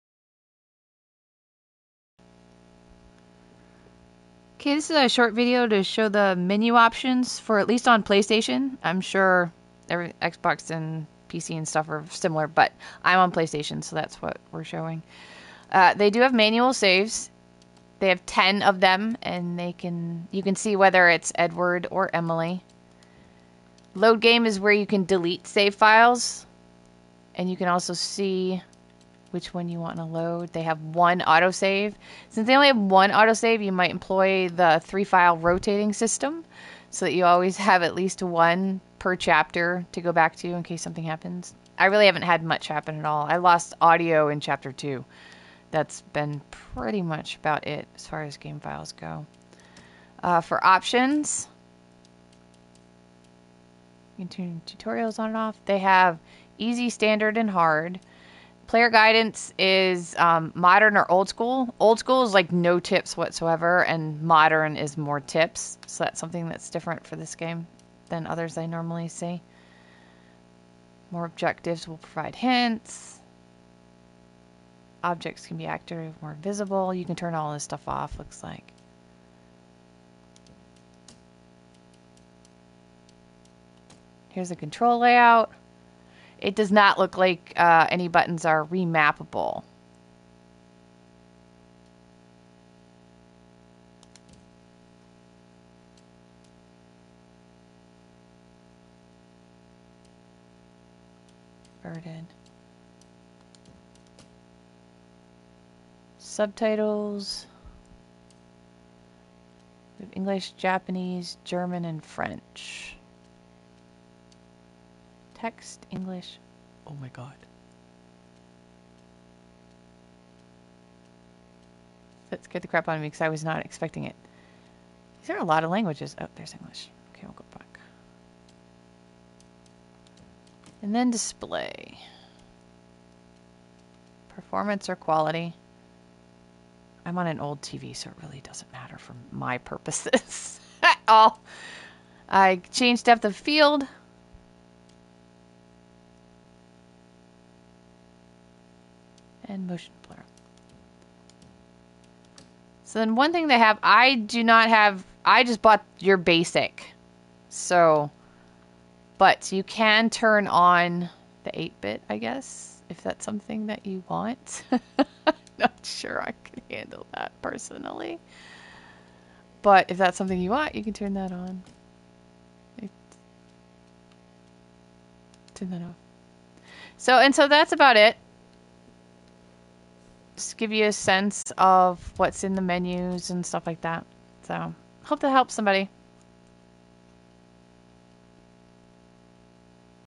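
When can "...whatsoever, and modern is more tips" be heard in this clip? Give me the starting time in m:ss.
1:03.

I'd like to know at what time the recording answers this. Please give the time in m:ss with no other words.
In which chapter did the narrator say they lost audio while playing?
0:44.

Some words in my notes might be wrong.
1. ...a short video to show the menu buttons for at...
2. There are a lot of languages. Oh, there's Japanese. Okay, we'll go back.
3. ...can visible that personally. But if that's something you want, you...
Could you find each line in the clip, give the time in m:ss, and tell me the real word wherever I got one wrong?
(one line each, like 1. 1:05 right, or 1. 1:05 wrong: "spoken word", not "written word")
1. 0:04 wrong: "options", not "buttons"
2. 2:05 wrong: "English", not "Japanese"
3. 2:46 wrong: "handle", not "visible".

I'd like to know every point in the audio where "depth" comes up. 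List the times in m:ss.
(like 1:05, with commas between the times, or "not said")
2:23.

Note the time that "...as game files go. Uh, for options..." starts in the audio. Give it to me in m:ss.
0:48.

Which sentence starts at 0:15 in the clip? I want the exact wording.
Uh, they do have manual saves.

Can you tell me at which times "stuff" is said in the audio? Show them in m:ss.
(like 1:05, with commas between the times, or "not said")
0:11, 1:17, 3:03.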